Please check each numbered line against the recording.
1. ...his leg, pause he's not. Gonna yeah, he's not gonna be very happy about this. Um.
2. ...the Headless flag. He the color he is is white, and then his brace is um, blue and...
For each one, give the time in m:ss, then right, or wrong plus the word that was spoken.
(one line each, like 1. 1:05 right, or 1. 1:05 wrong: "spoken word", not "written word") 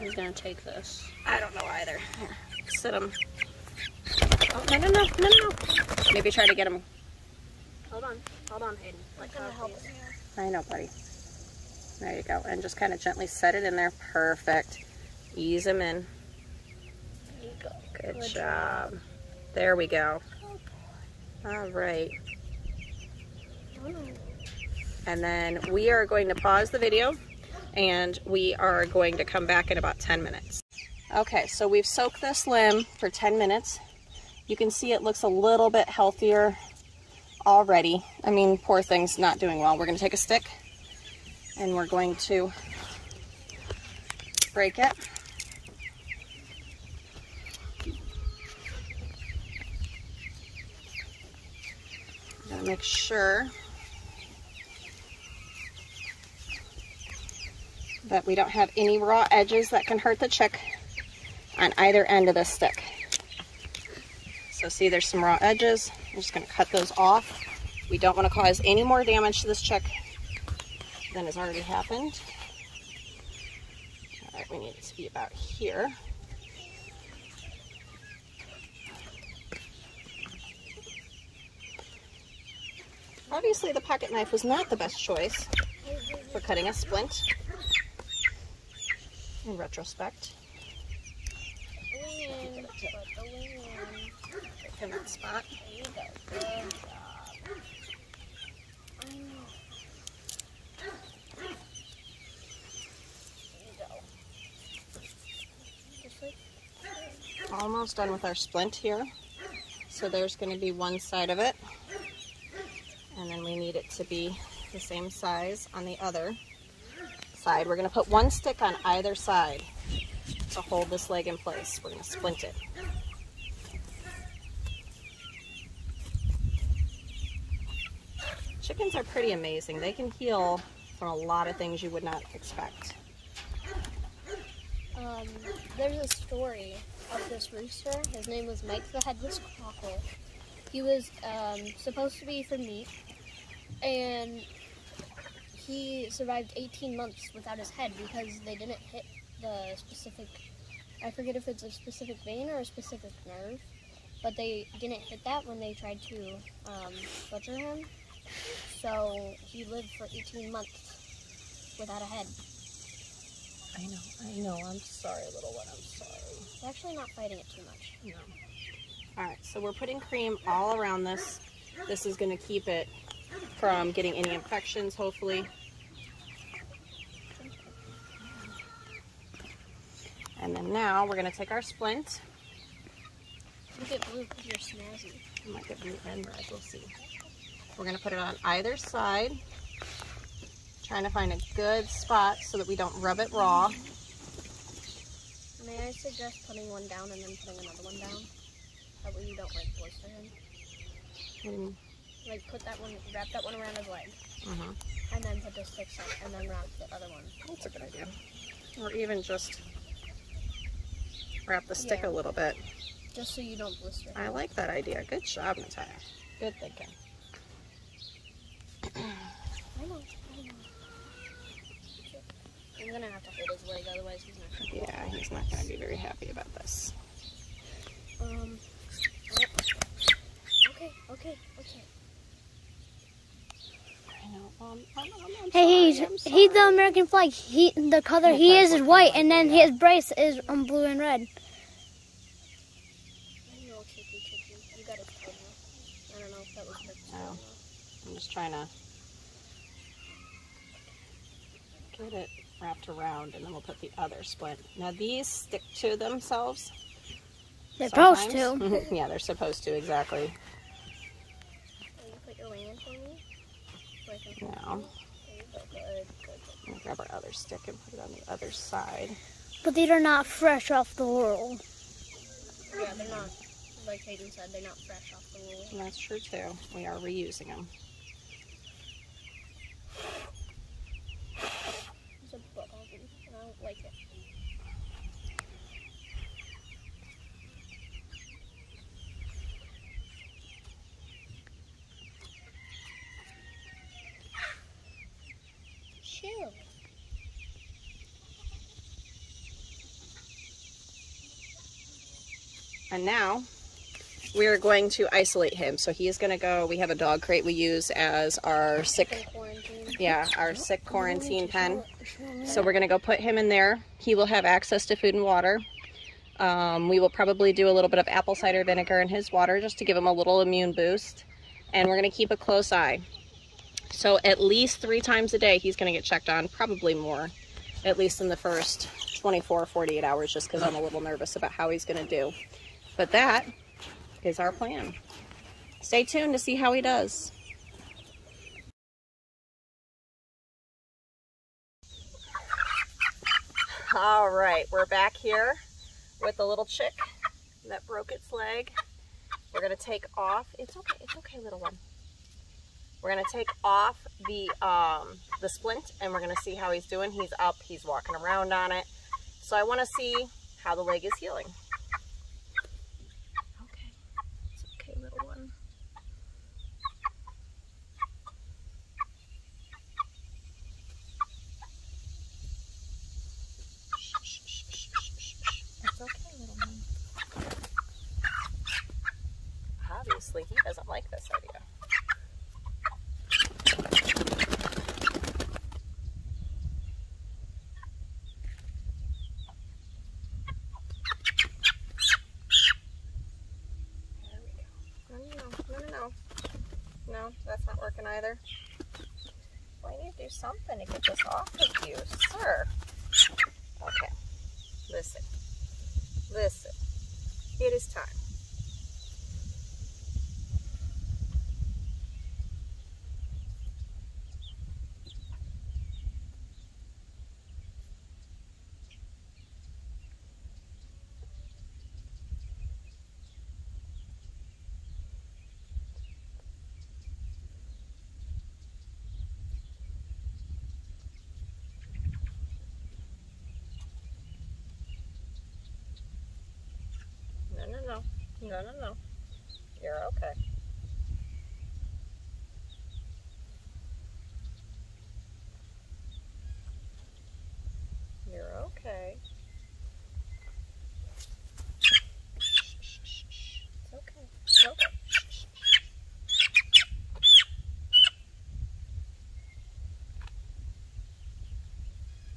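1. 3:43 wrong: "otherwise", not "pause"
2. 3:56 wrong: "American", not "Headless".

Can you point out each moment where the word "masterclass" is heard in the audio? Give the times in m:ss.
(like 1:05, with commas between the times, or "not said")
not said.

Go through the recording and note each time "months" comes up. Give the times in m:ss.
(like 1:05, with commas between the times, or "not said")
2:26, 2:40.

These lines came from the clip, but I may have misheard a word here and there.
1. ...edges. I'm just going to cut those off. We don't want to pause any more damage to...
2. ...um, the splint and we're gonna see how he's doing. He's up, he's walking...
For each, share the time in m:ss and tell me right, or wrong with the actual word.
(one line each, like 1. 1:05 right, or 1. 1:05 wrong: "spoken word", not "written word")
1. 1:05 wrong: "cause", not "pause"
2. 5:54 right.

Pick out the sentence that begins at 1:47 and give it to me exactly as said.
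Almost done with our splint here.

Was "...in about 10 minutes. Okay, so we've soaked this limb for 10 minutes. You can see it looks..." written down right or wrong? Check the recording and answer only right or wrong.
right.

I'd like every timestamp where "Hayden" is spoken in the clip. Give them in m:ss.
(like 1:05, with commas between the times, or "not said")
0:08, 4:34.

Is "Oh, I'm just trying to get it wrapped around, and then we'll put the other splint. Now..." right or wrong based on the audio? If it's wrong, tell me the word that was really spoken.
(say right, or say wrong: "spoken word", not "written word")
right.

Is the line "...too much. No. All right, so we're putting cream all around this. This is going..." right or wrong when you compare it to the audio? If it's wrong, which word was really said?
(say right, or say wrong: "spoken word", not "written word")
right.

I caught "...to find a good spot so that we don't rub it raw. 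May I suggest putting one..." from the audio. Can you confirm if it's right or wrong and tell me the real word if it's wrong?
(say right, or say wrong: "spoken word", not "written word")
right.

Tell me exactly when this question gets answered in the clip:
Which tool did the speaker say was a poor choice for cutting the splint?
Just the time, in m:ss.
1:23.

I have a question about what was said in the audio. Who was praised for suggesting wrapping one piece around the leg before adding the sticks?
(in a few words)
Natalia.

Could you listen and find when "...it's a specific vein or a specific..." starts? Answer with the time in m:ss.
2:31.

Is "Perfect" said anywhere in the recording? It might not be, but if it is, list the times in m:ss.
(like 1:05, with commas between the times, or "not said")
0:14.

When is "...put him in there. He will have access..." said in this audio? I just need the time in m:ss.
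5:12.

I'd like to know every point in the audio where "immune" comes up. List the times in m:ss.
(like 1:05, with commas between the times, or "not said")
5:20.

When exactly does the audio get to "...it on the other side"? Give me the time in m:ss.
4:27.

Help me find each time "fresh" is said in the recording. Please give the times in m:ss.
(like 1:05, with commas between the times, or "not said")
4:30, 4:34.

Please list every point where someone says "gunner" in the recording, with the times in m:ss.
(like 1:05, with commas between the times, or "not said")
not said.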